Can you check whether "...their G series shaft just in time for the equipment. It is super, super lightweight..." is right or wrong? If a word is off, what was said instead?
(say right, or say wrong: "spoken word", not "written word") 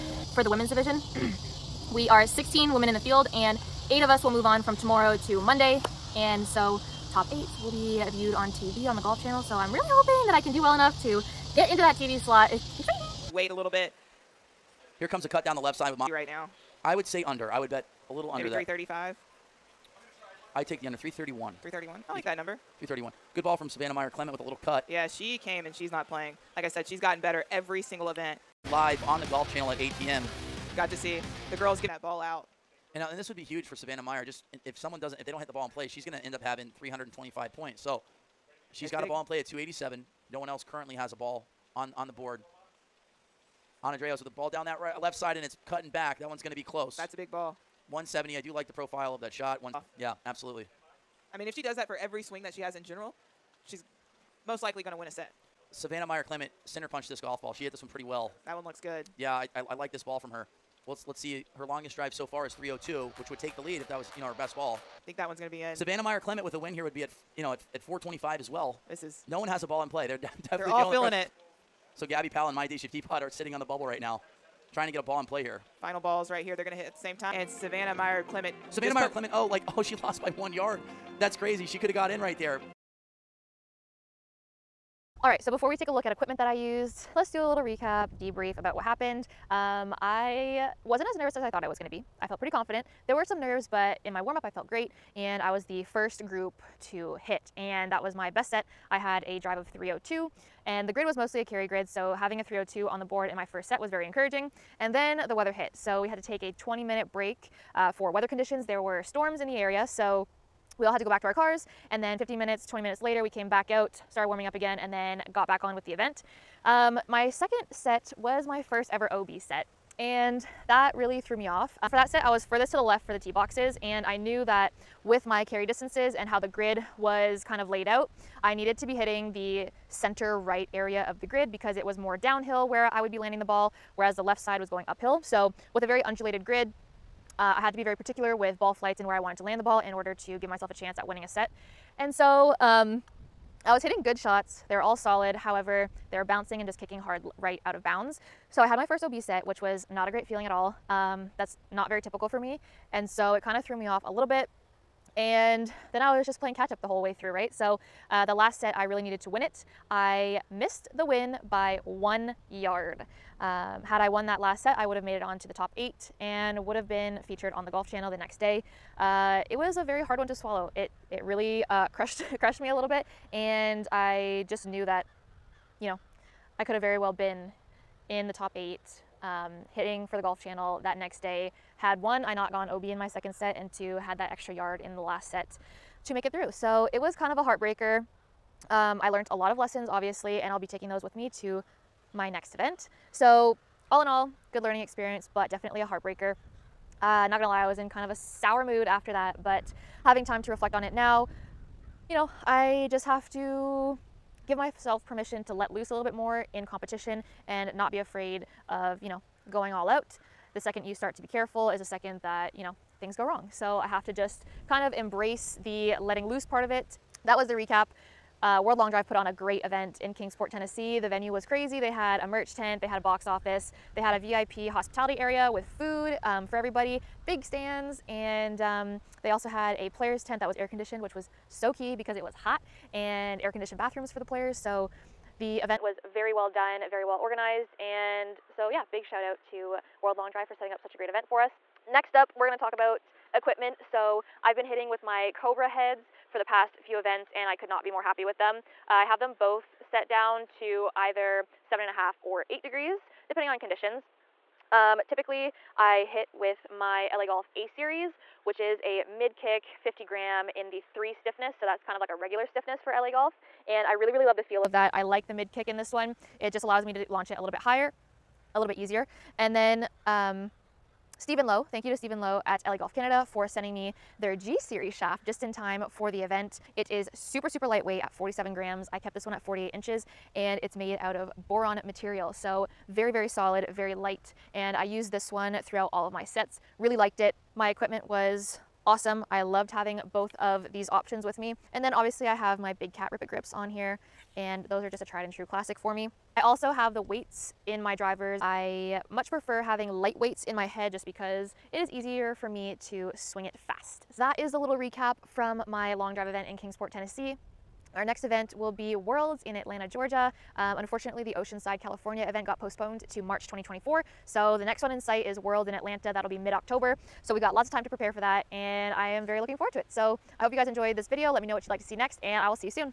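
wrong: "event", not "equipment".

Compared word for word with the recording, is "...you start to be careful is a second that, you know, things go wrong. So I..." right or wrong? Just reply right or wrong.
right.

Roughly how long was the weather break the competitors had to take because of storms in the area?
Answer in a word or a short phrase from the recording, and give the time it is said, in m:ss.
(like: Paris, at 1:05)
20 minutes, at 1:46.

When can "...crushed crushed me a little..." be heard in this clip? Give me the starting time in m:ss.
2:51.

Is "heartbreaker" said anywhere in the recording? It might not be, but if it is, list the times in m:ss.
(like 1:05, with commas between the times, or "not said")
3:07, 3:15.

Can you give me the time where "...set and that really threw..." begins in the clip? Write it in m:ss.
1:59.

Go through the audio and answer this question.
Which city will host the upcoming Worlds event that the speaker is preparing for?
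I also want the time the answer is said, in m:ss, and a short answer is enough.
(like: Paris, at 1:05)
Atlanta, Georgia, at 5:09.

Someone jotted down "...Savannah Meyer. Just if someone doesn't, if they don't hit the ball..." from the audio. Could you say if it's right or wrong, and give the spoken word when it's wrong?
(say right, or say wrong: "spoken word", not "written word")
right.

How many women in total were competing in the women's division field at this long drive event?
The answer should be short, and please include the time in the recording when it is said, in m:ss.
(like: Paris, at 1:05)
16, at 0:02.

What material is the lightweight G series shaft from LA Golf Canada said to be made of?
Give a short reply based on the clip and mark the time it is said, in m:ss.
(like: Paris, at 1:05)
Boron, at 4:41.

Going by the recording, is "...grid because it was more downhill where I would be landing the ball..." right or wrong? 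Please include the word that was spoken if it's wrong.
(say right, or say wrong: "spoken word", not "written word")
right.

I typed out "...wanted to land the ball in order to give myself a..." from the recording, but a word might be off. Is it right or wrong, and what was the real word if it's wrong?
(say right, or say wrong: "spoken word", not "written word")
right.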